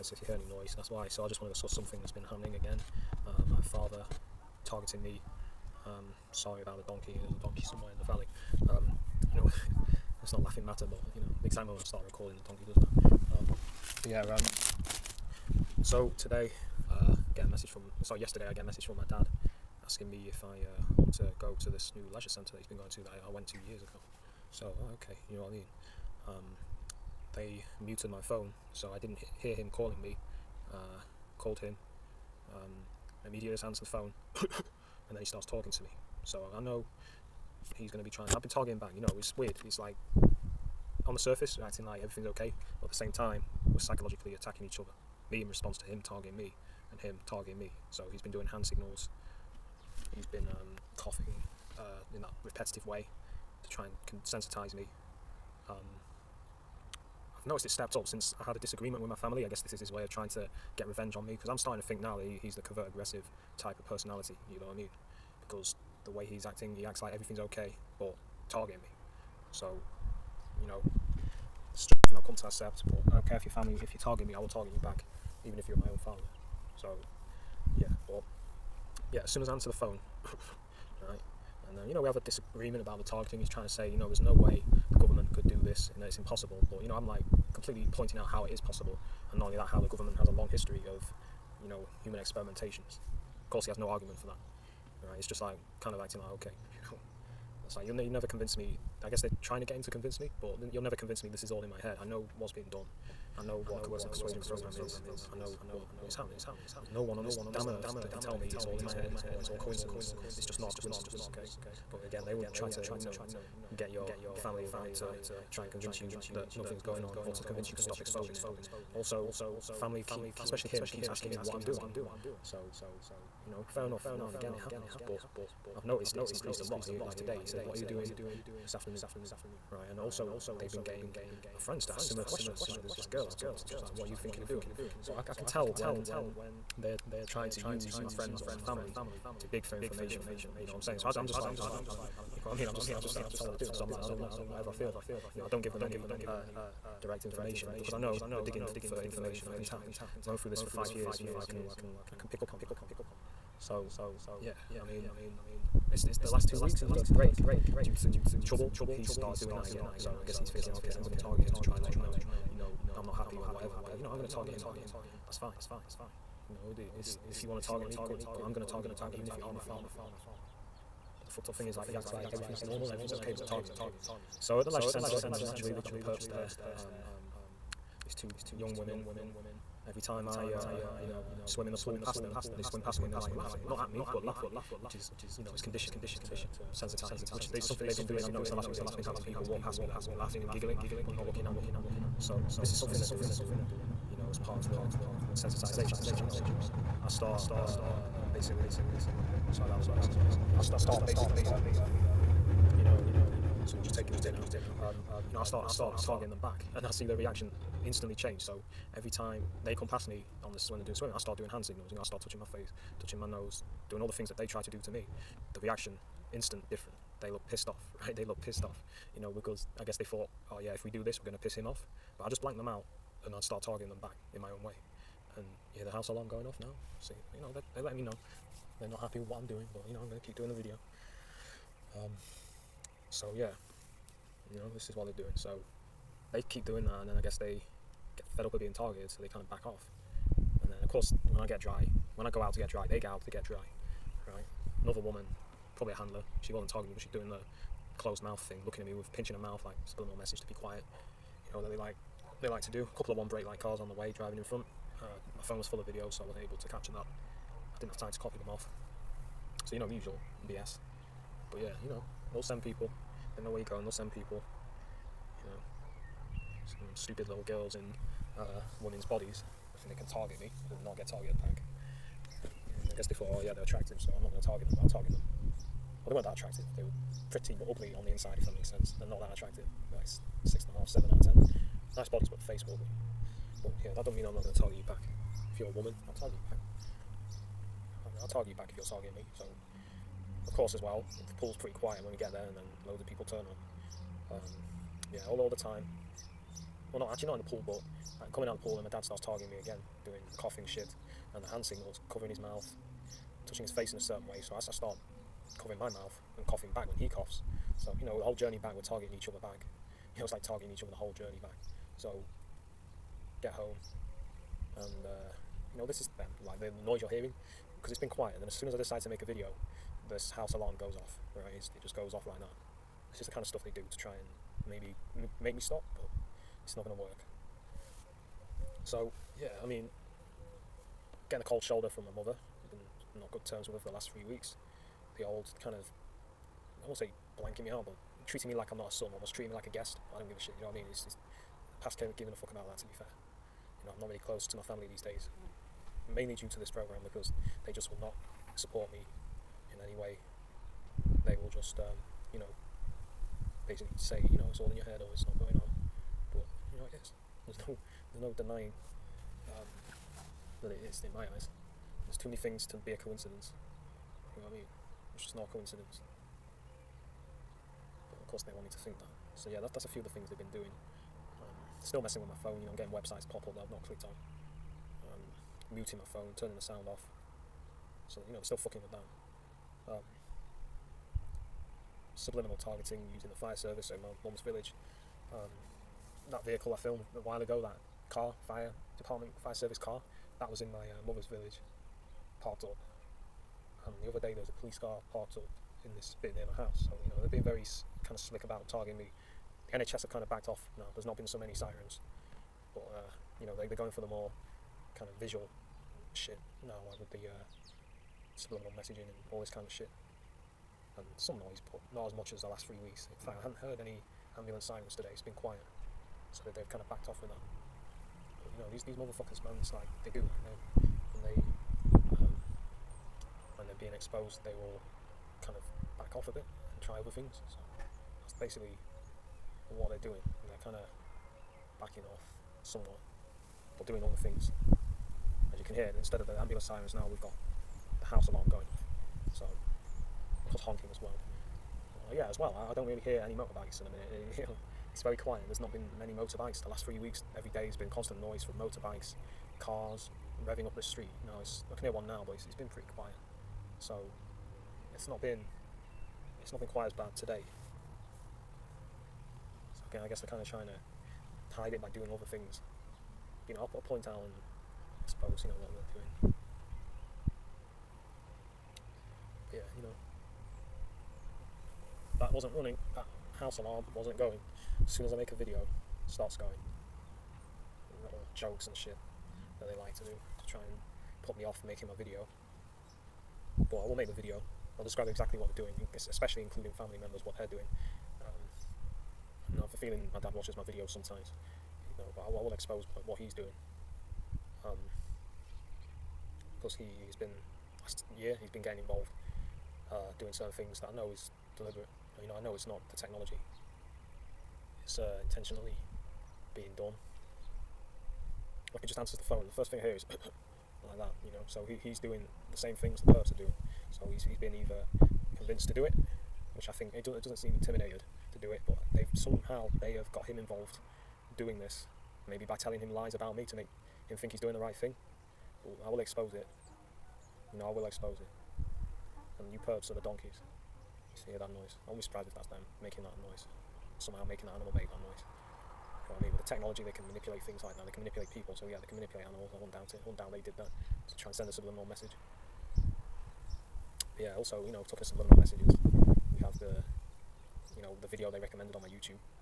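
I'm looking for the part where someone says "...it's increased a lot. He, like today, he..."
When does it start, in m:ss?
2:06.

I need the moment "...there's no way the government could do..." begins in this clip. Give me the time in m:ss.
1:24.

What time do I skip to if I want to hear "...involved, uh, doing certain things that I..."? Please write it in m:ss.
8:18.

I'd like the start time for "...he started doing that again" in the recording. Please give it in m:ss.
2:38.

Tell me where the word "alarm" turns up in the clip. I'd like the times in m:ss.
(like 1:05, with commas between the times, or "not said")
3:46, 5:20, 7:18, 7:53.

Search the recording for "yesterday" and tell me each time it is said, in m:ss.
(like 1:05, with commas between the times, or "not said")
0:18.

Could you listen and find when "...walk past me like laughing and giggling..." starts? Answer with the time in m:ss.
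3:09.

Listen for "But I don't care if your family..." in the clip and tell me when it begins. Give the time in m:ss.
1:12.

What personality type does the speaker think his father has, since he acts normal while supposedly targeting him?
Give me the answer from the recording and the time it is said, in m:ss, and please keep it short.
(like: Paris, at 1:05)
covert aggressive, at 1:02.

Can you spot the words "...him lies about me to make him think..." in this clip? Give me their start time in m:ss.
8:42.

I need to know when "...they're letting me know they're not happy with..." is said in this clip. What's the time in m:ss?
3:47.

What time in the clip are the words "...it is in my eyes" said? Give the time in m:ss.
6:00.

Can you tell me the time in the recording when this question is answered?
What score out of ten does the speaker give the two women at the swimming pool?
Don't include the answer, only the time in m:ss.
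4:40.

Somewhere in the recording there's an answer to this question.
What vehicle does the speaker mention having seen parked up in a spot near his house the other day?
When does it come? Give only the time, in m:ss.
6:34.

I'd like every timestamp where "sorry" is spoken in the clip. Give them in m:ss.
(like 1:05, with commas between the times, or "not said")
0:06, 0:18, 3:19.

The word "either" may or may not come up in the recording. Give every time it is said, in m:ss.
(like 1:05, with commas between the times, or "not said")
8:34.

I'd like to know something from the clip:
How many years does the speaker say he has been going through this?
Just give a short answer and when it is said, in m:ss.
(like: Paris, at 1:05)
5, at 2:30.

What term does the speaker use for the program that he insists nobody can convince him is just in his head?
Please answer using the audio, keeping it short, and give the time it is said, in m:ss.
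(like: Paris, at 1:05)
coercive persuasion program, at 1:43.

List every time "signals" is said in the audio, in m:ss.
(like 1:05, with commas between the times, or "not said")
0:48, 3:31, 5:01.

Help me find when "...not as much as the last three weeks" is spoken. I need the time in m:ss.
6:51.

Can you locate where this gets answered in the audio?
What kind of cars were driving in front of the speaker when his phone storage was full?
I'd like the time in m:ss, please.
4:13.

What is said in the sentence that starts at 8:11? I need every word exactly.
You know, but I, I will expose like, what he's doing.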